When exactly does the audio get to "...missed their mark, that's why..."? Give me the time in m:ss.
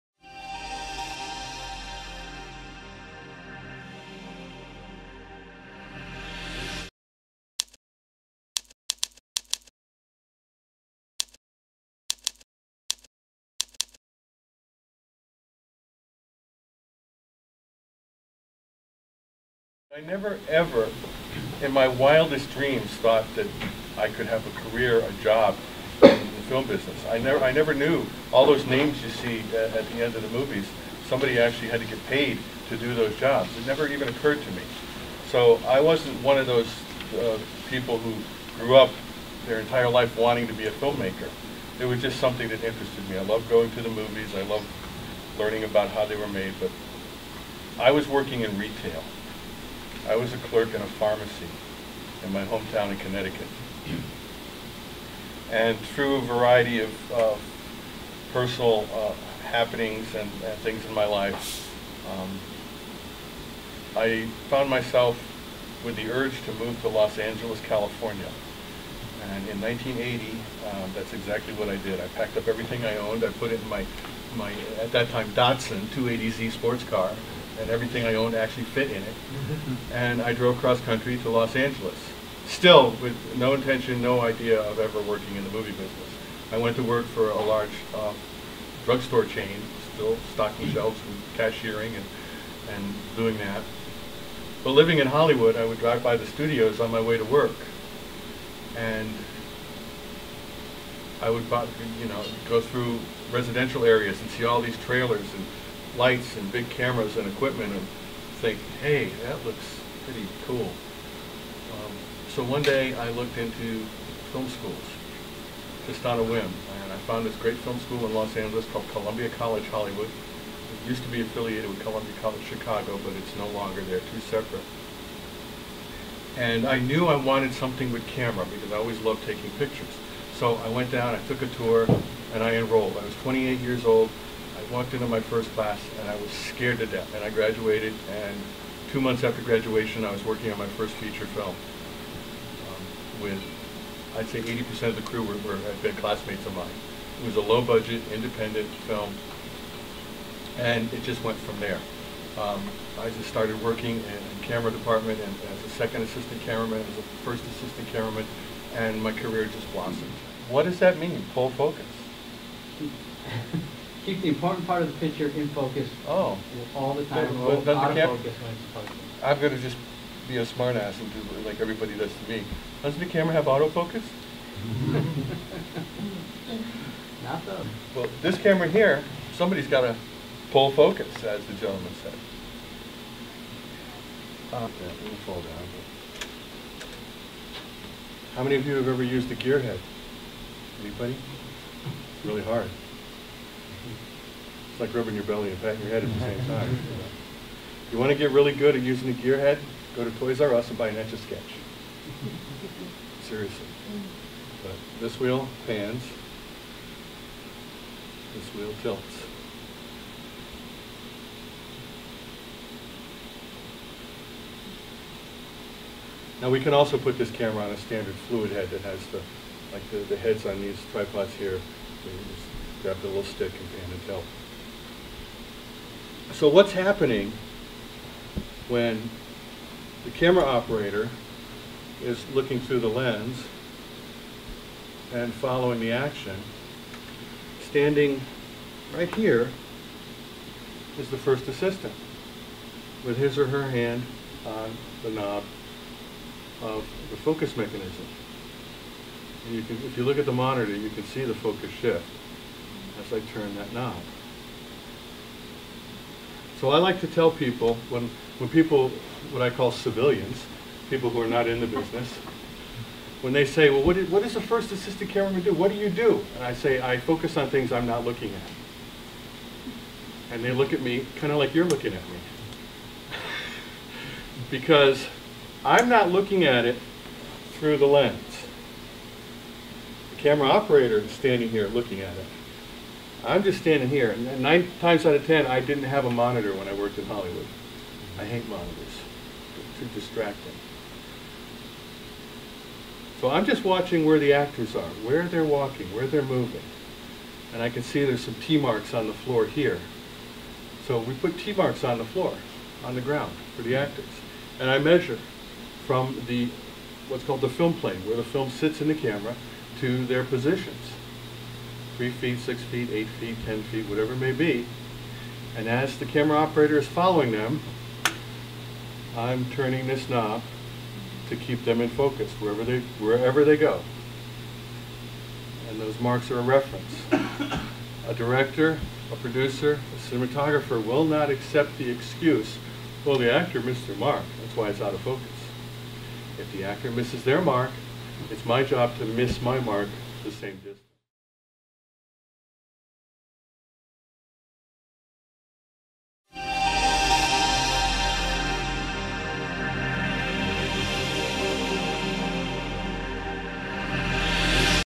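5:33.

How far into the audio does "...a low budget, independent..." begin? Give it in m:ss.
2:27.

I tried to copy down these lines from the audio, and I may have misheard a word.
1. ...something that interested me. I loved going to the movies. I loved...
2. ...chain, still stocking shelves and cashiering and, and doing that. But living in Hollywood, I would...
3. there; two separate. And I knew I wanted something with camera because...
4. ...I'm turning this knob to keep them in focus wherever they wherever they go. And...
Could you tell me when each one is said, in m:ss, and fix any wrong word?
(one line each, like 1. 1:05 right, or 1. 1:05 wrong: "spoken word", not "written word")
1. 0:42 right
2. 1:29 right
3. 2:03 right
4. 5:19 right.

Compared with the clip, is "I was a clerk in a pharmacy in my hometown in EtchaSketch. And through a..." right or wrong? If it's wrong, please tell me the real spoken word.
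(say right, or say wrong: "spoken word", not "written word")
wrong: "Connecticut", not "EtchaSketch".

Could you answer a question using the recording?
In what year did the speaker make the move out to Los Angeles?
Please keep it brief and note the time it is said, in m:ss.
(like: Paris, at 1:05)
1980, at 1:09.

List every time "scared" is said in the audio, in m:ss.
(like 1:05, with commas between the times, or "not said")
2:16.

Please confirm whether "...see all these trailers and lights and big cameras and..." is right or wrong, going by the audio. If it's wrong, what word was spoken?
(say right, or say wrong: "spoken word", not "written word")
right.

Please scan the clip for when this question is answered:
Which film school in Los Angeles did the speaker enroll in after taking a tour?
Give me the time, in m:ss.
1:58.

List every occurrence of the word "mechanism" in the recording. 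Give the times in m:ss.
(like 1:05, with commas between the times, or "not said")
4:07.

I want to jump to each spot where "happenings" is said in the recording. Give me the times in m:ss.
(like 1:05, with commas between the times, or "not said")
0:59, 3:46.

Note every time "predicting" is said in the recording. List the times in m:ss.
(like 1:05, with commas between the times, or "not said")
not said.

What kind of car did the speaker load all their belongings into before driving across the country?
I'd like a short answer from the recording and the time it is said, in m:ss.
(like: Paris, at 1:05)
Datsun 280Z, at 1:15.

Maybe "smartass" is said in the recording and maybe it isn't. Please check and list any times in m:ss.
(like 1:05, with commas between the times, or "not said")
2:50.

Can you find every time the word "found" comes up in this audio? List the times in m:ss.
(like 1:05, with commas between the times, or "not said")
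1:04, 1:56.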